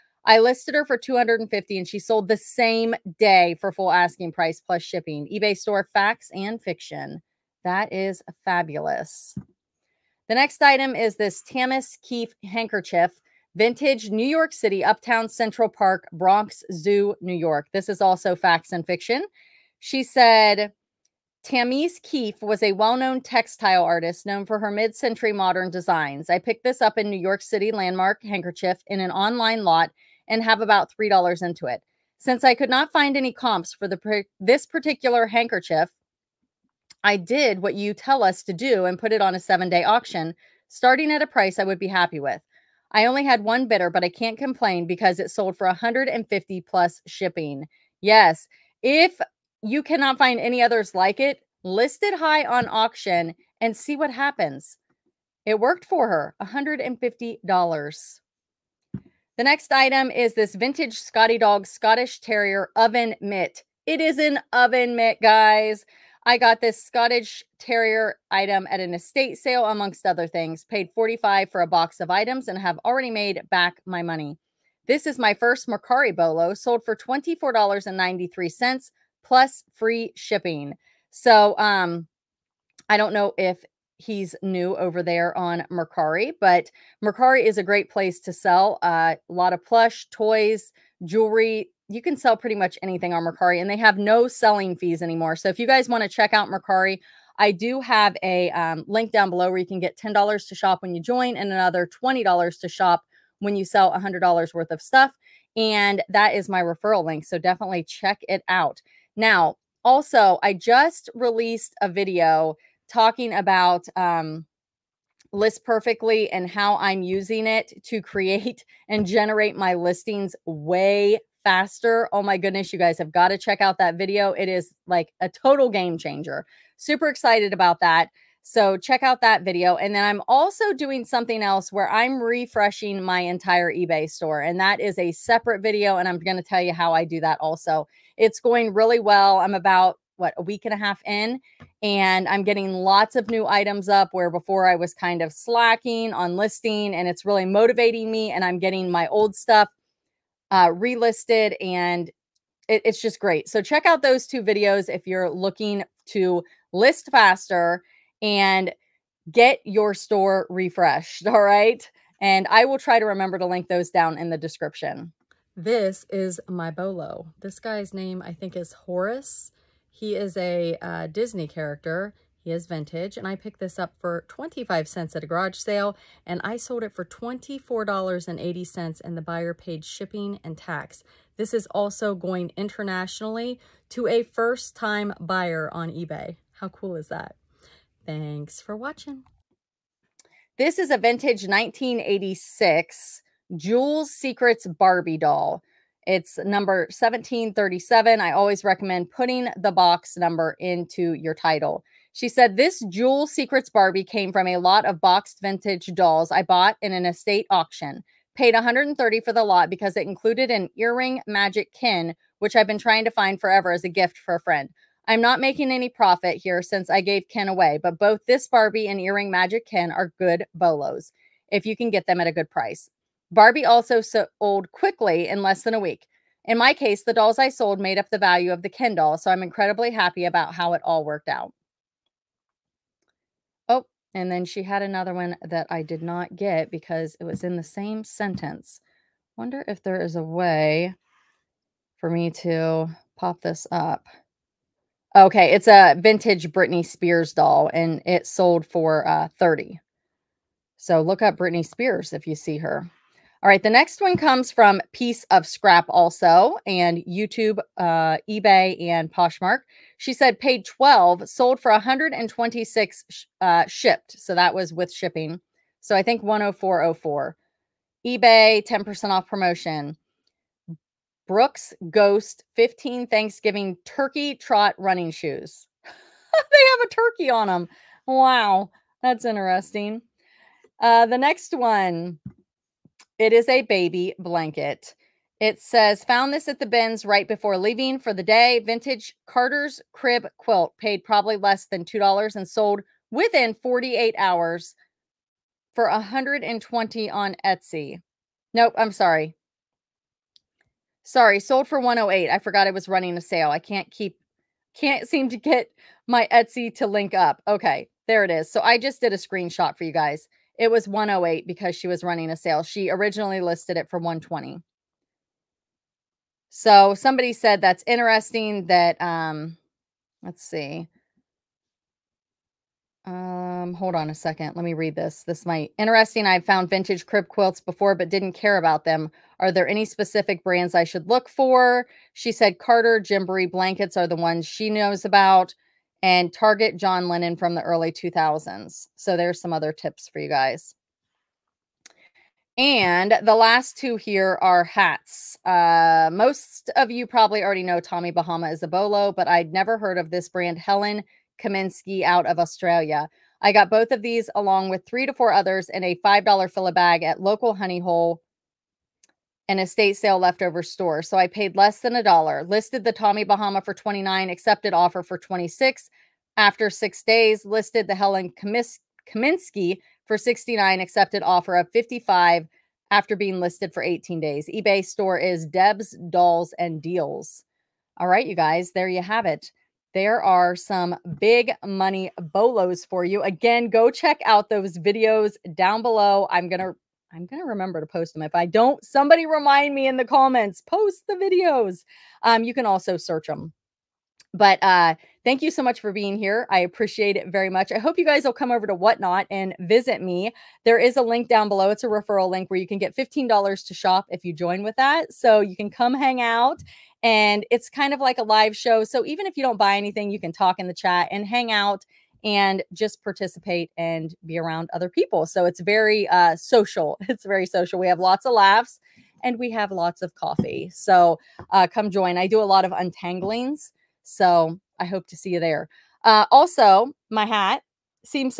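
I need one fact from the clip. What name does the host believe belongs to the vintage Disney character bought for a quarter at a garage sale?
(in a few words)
Horace.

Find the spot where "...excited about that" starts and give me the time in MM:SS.
02:07.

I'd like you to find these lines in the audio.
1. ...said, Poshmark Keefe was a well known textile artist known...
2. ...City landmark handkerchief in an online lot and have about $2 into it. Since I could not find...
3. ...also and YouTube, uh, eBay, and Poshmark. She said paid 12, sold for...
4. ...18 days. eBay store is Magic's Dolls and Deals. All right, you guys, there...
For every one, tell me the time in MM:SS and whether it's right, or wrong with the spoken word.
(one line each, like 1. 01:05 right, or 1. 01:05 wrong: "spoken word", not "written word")
1. 00:20 wrong: "Tammis", not "Poshmark"
2. 00:27 wrong: "3", not "2"
3. 04:15 right
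4. 06:13 wrong: "Deb", not "Magic".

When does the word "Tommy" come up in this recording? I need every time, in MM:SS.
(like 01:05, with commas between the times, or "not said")
05:47, 06:02.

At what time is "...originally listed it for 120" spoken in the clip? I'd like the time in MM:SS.
05:12.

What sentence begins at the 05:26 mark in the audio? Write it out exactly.
I found vintage crib quilts before but didn't care about them.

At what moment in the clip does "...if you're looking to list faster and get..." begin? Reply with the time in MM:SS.
02:34.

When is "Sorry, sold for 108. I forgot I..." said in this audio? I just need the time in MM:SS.
05:01.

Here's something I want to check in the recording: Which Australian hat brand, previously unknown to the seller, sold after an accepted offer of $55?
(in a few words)
Helen Kaminski.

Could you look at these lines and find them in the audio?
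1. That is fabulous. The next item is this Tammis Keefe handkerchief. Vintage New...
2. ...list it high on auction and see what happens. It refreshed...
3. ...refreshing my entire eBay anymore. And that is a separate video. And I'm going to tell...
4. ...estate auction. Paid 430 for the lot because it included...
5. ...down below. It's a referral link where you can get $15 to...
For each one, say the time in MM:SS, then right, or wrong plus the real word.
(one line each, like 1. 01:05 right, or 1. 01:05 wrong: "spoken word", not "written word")
1. 00:07 right
2. 00:51 wrong: "worked", not "refreshed"
3. 02:12 wrong: "store", not "anymore"
4. 03:27 wrong: "130", not "430"
5. 06:41 right.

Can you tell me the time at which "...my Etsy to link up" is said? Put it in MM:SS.
05:06.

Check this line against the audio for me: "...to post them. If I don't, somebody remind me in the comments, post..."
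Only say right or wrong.
right.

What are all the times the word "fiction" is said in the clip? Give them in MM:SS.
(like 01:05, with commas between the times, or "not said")
00:06, 00:18.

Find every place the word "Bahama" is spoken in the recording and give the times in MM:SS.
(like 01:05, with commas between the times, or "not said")
05:48, 06:03.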